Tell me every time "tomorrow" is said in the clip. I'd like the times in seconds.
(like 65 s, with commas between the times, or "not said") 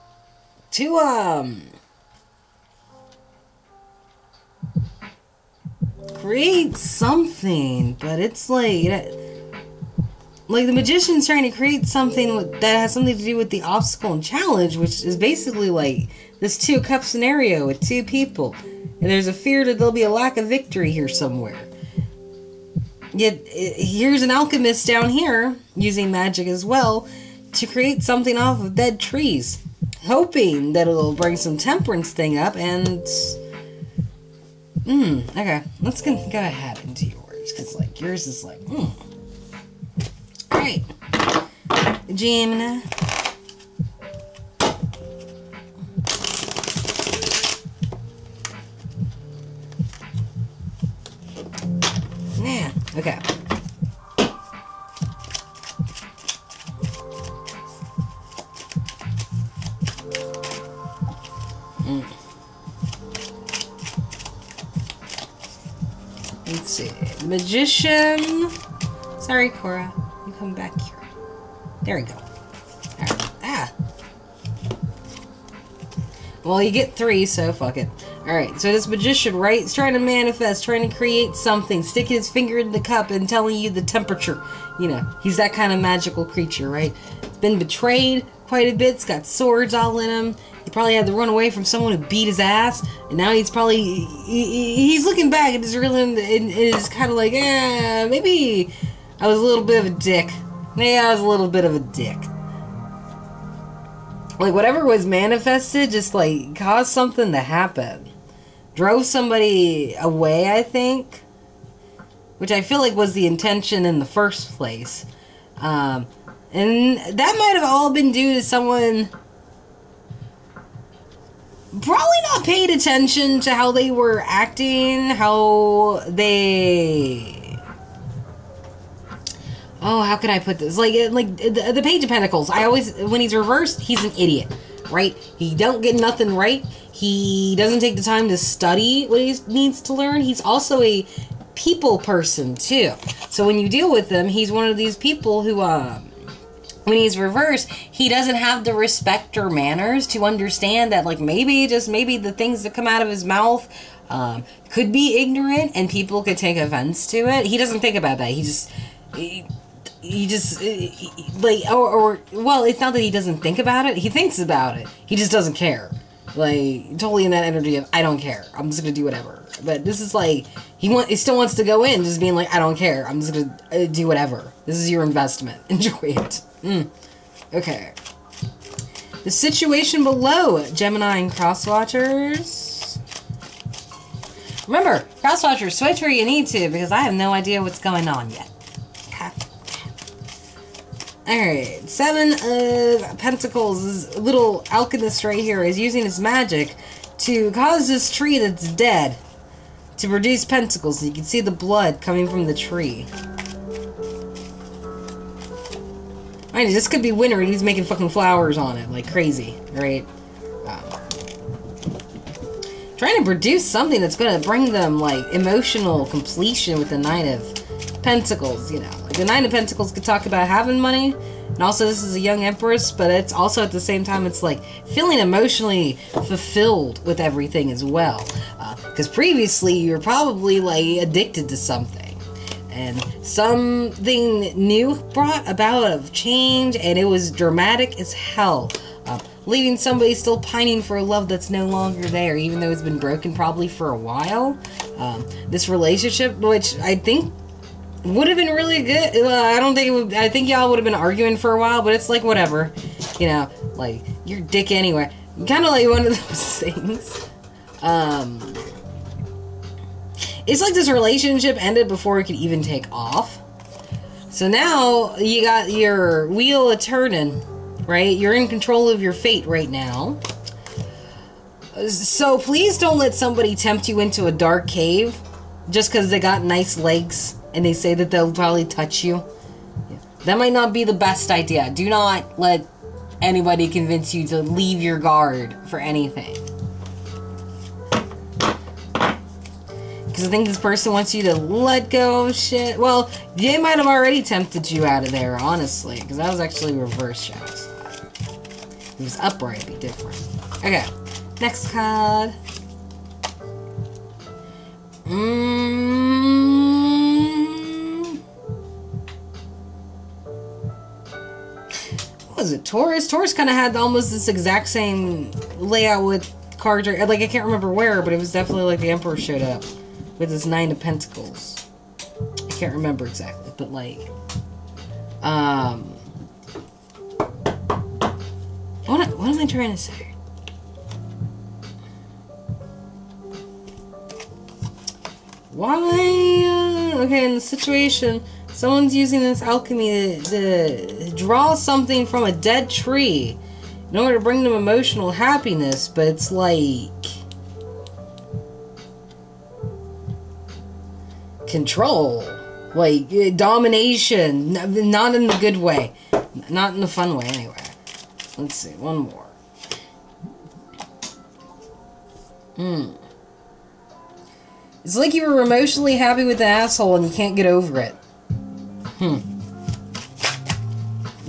not said.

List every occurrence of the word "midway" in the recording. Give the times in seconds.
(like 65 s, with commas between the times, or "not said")
not said.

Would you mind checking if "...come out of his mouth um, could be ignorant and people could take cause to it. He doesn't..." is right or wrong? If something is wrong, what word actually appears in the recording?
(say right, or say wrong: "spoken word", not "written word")
wrong: "offense", not "cause".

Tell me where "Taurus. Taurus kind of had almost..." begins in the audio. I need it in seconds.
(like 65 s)
312 s.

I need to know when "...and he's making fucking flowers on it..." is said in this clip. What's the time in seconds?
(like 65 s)
207 s.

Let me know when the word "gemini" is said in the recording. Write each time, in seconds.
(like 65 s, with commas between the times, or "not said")
42 s, 180 s.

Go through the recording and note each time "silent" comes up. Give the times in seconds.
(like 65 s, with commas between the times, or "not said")
not said.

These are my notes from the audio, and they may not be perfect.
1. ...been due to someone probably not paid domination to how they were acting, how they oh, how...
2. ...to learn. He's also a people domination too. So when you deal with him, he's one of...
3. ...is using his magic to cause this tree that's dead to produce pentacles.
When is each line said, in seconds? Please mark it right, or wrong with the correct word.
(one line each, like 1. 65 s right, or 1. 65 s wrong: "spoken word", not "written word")
1. 117 s wrong: "attention", not "domination"
2. 139 s wrong: "person", not "domination"
3. 195 s right.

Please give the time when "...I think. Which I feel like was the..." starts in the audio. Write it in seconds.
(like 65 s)
110 s.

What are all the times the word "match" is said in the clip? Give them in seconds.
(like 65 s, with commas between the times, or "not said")
not said.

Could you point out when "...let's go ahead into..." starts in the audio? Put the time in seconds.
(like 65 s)
35 s.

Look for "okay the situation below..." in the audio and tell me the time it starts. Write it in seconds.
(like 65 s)
177 s.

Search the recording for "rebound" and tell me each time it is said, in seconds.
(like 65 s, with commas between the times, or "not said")
not said.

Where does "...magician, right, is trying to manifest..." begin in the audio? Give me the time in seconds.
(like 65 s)
78 s.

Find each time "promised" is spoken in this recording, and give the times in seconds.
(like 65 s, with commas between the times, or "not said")
not said.